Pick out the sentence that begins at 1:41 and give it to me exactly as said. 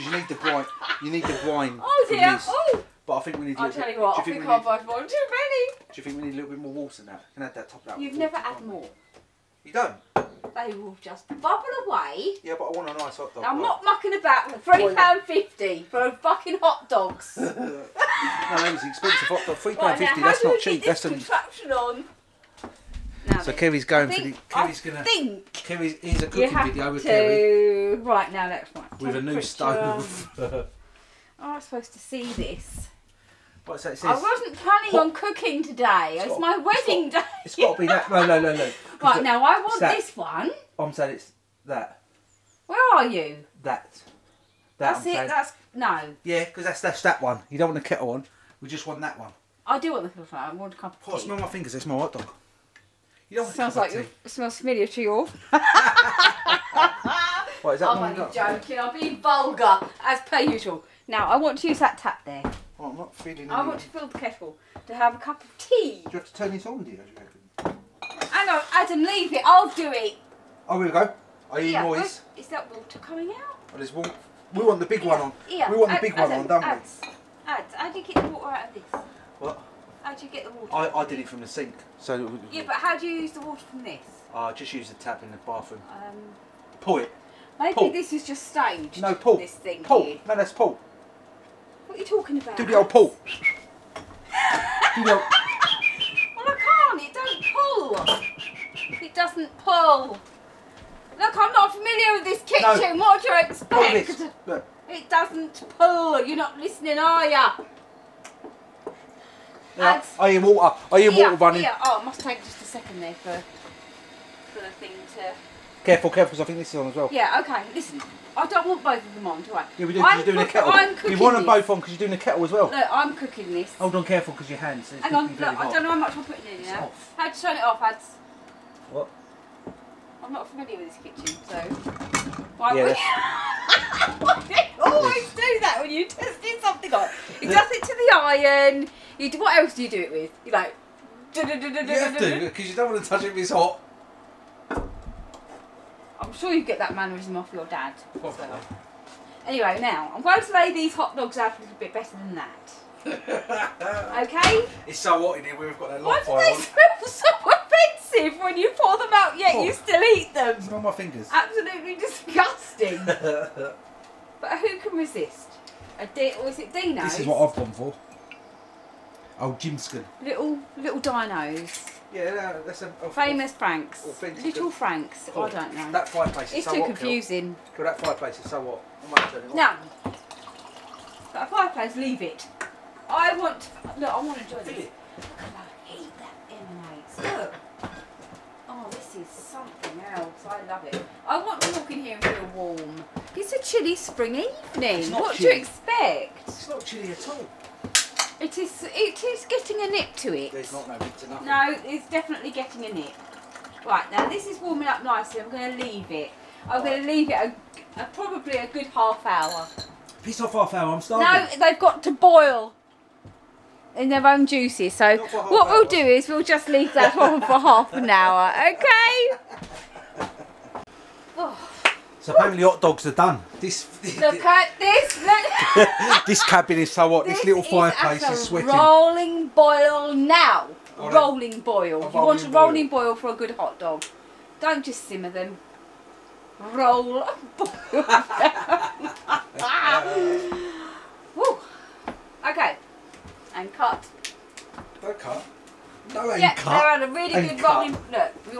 Look, I'm not familiar with this kitchen.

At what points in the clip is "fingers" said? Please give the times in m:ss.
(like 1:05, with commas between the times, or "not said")
0:51, 2:40.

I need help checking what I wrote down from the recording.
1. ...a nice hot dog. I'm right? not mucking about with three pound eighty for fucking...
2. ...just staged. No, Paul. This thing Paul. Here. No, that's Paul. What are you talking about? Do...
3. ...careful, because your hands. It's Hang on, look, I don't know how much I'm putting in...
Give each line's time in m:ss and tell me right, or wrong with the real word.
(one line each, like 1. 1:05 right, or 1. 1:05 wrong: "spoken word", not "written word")
1. 0:12 wrong: "fifty", not "eighty"
2. 1:28 right
3. 2:04 right.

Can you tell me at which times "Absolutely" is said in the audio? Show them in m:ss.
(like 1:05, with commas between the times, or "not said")
2:41.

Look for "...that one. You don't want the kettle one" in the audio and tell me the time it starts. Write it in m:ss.
0:47.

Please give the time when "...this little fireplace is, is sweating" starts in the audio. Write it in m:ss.
3:47.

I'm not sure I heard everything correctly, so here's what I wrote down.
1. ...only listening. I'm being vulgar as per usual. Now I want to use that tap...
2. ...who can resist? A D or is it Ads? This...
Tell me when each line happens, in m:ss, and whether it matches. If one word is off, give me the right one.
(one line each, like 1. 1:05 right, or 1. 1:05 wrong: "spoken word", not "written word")
1. 0:58 wrong: "joking", not "listening"
2. 2:44 wrong: "Dino", not "Ads".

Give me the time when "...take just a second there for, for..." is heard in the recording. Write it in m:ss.
1:52.